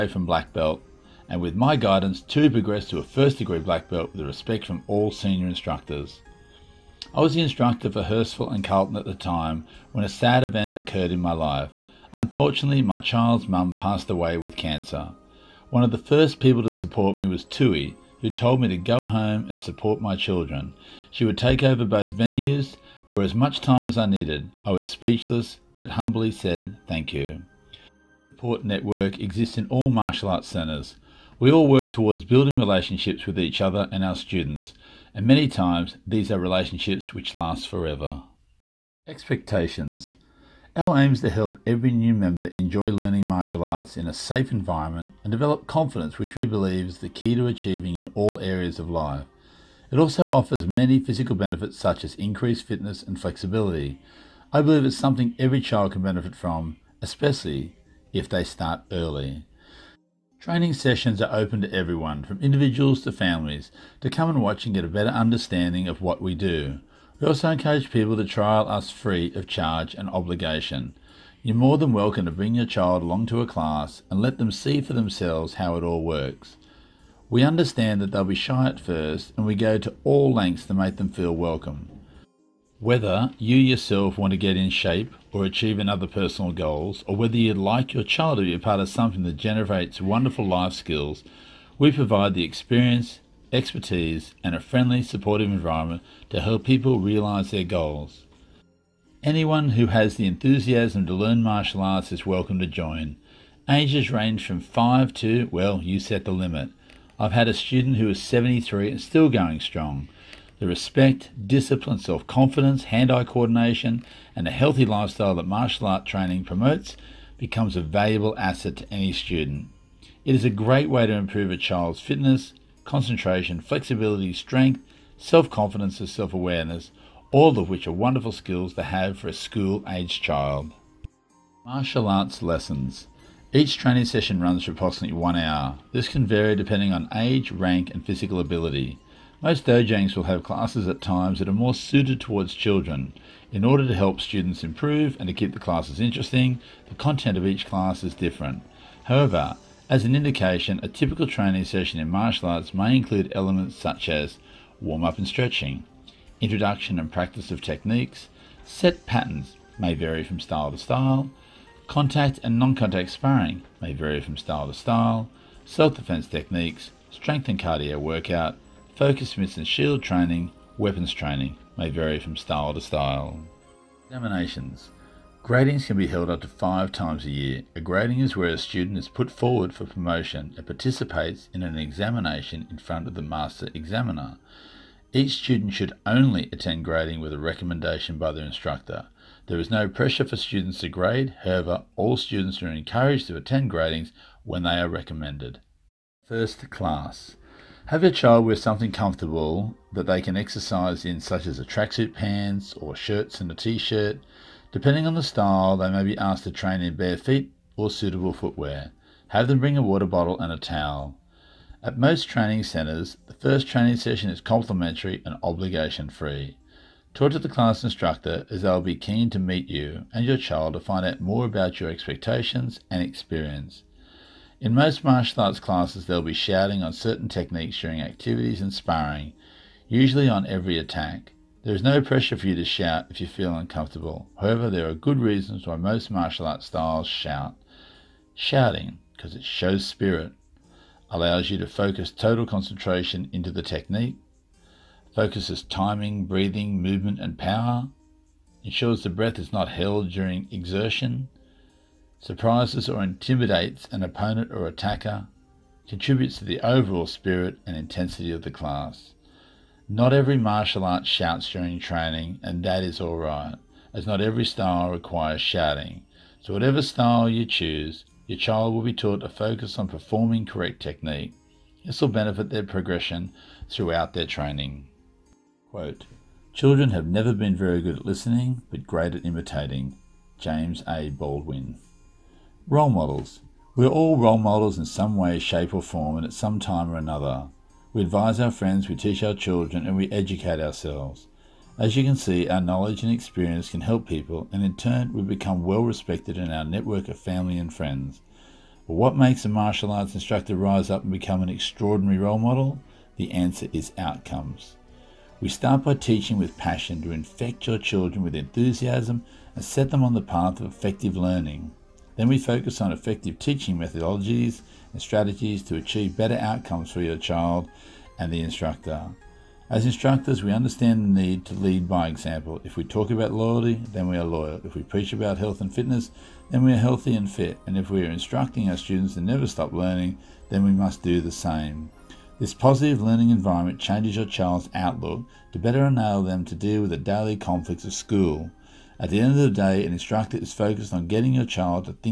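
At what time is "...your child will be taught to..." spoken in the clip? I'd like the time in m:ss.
4:28.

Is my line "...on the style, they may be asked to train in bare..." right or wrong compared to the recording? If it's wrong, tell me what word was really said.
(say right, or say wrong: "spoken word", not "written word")
right.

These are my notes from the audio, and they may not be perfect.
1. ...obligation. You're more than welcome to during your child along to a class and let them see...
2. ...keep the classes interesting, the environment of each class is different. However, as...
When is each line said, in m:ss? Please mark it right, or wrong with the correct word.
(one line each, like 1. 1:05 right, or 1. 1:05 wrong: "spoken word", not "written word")
1. 1:10 wrong: "bring", not "during"
2. 2:25 wrong: "content", not "environment".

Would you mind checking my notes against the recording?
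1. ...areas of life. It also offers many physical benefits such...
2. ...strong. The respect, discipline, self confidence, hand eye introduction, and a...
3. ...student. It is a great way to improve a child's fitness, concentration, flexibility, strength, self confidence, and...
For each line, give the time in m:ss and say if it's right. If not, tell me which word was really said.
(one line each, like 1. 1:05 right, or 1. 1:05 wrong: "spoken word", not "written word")
1. 0:48 right
2. 1:49 wrong: "coordination", not "introduction"
3. 1:59 right.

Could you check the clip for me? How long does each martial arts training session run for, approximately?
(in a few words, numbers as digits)
1 hour.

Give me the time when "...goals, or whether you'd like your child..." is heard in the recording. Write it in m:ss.
1:26.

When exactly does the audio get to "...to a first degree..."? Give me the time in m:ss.
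0:02.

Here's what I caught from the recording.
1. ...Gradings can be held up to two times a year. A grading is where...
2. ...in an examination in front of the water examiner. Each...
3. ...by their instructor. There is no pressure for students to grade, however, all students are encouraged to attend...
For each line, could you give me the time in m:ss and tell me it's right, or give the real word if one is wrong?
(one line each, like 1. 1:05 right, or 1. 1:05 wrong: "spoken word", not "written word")
1. 2:55 wrong: "five", not "two"
2. 3:01 wrong: "master", not "water"
3. 3:08 right.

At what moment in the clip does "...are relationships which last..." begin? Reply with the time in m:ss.
0:36.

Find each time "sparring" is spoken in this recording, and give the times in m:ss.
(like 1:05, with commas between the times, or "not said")
2:43, 3:48.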